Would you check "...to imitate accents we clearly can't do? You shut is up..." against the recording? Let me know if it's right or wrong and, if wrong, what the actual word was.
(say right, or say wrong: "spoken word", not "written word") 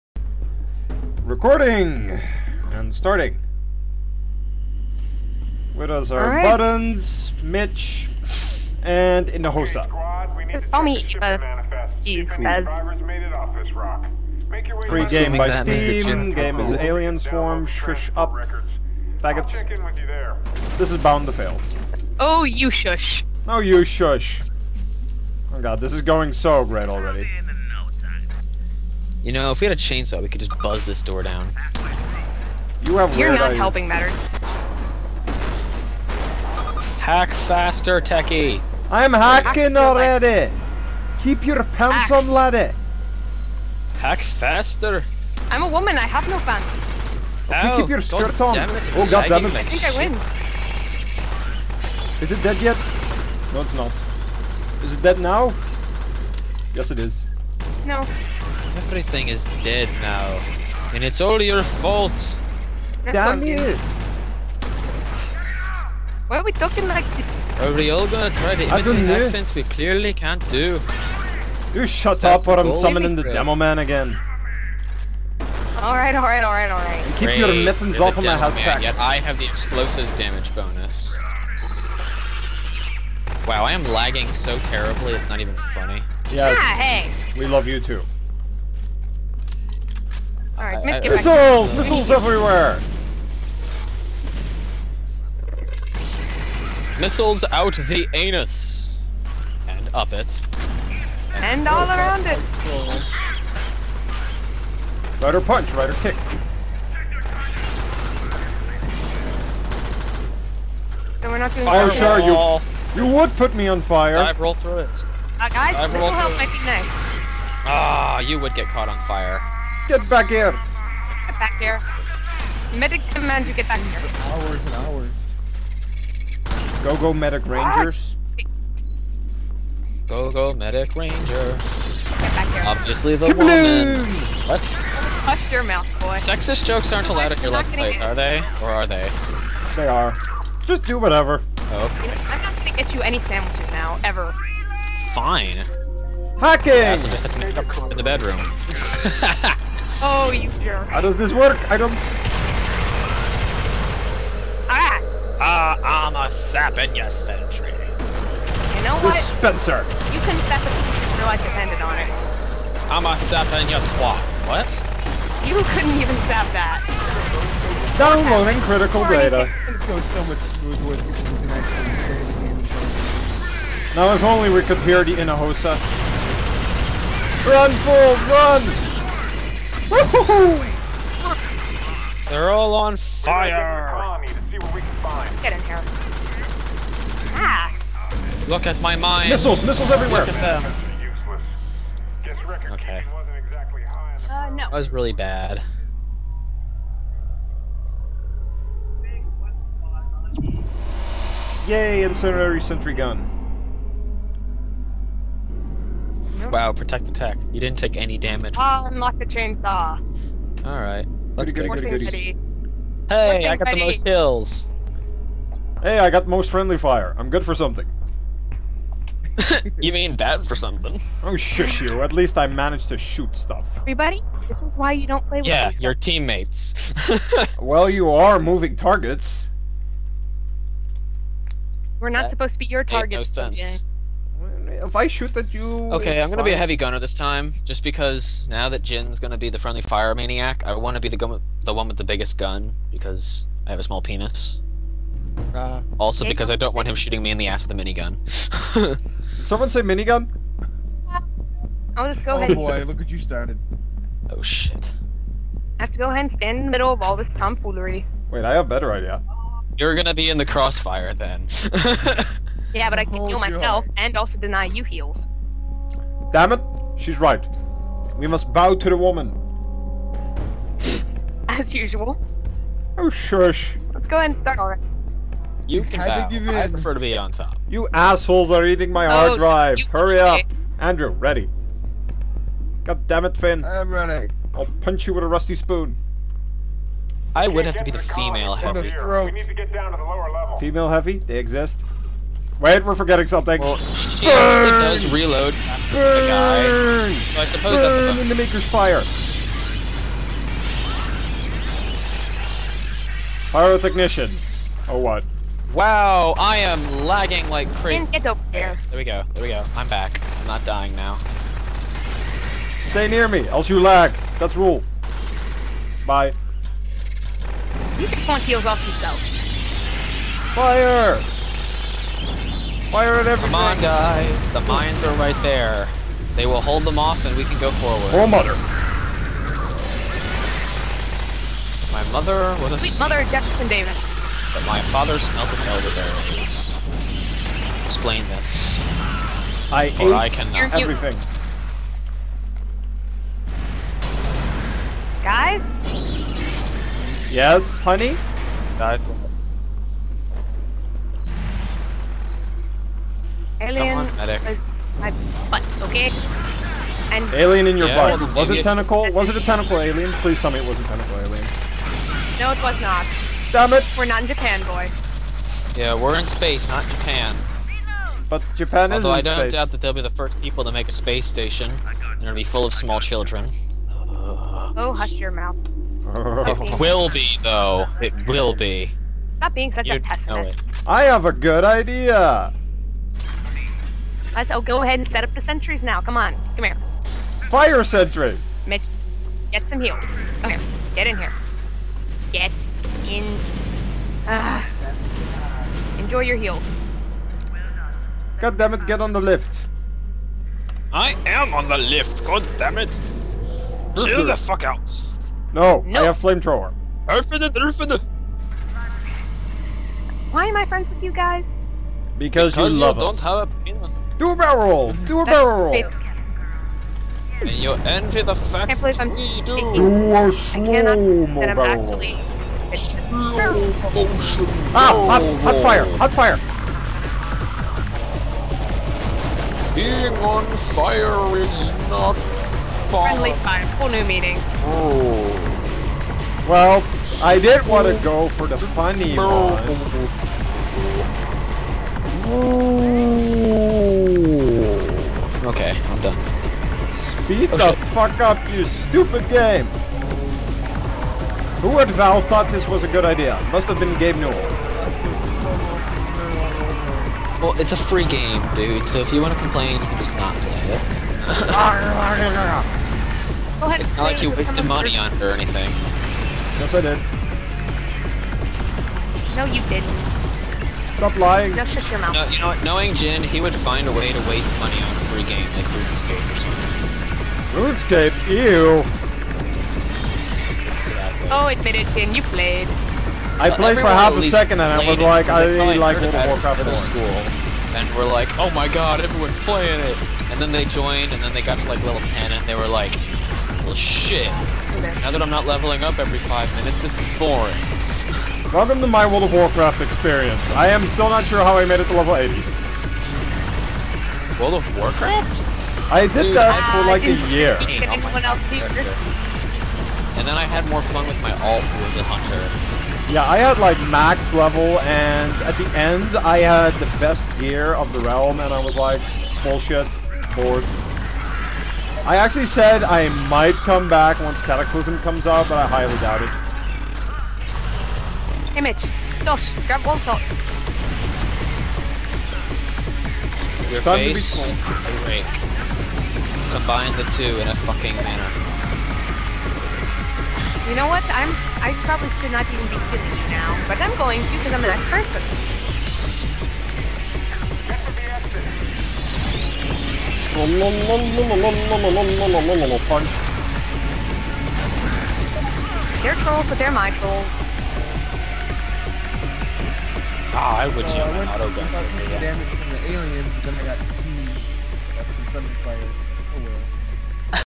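right.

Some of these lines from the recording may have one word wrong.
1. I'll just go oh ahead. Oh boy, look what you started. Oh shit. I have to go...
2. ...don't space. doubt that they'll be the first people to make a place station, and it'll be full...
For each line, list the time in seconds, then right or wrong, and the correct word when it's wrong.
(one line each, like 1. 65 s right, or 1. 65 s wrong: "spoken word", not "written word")
1. 251 s right
2. 369 s wrong: "space", not "place".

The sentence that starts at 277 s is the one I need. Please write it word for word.
You assholes are eating my hard oh, drive.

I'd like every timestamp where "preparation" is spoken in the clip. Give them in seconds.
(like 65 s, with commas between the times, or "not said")
not said.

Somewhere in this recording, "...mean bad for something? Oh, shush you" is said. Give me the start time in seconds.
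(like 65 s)
219 s.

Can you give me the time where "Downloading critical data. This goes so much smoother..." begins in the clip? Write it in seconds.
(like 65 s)
167 s.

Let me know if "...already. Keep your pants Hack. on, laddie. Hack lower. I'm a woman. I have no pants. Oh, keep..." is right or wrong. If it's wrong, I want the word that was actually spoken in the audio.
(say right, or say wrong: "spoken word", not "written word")
wrong: "faster", not "lower".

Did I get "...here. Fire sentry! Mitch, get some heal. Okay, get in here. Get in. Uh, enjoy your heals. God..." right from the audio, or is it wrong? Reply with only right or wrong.
right.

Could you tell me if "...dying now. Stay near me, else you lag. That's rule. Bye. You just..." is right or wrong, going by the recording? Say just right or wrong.
right.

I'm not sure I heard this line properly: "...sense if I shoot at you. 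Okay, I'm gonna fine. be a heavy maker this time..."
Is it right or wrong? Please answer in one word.
wrong.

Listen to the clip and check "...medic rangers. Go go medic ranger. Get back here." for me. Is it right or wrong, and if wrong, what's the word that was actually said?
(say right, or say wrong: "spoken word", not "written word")
right.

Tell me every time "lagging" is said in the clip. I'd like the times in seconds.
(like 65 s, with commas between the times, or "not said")
83 s, 307 s.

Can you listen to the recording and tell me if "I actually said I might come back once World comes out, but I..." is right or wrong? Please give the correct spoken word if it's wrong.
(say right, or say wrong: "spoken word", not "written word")
wrong: "Cataclysm", not "World".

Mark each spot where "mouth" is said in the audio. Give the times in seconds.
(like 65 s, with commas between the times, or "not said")
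135 s, 375 s, 471 s.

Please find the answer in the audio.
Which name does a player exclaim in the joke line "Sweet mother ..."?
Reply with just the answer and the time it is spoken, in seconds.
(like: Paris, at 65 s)
Jefferson Davis, at 333 s.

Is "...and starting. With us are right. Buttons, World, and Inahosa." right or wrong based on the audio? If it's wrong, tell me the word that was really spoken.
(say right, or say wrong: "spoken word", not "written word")
wrong: "Mitch", not "World".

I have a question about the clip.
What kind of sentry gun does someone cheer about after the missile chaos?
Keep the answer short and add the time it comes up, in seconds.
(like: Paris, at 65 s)
incendiary, at 202 s.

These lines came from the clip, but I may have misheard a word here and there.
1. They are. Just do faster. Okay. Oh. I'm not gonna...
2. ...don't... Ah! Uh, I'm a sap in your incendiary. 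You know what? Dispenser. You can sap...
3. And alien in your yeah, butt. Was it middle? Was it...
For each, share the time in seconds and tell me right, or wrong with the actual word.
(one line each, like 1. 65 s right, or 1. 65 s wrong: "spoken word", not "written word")
1. 139 s wrong: "whatever", not "faster"
2. 151 s wrong: "sentry", not "incendiary"
3. 357 s wrong: "tentacle", not "middle".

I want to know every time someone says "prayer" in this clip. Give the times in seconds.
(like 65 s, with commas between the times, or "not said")
not said.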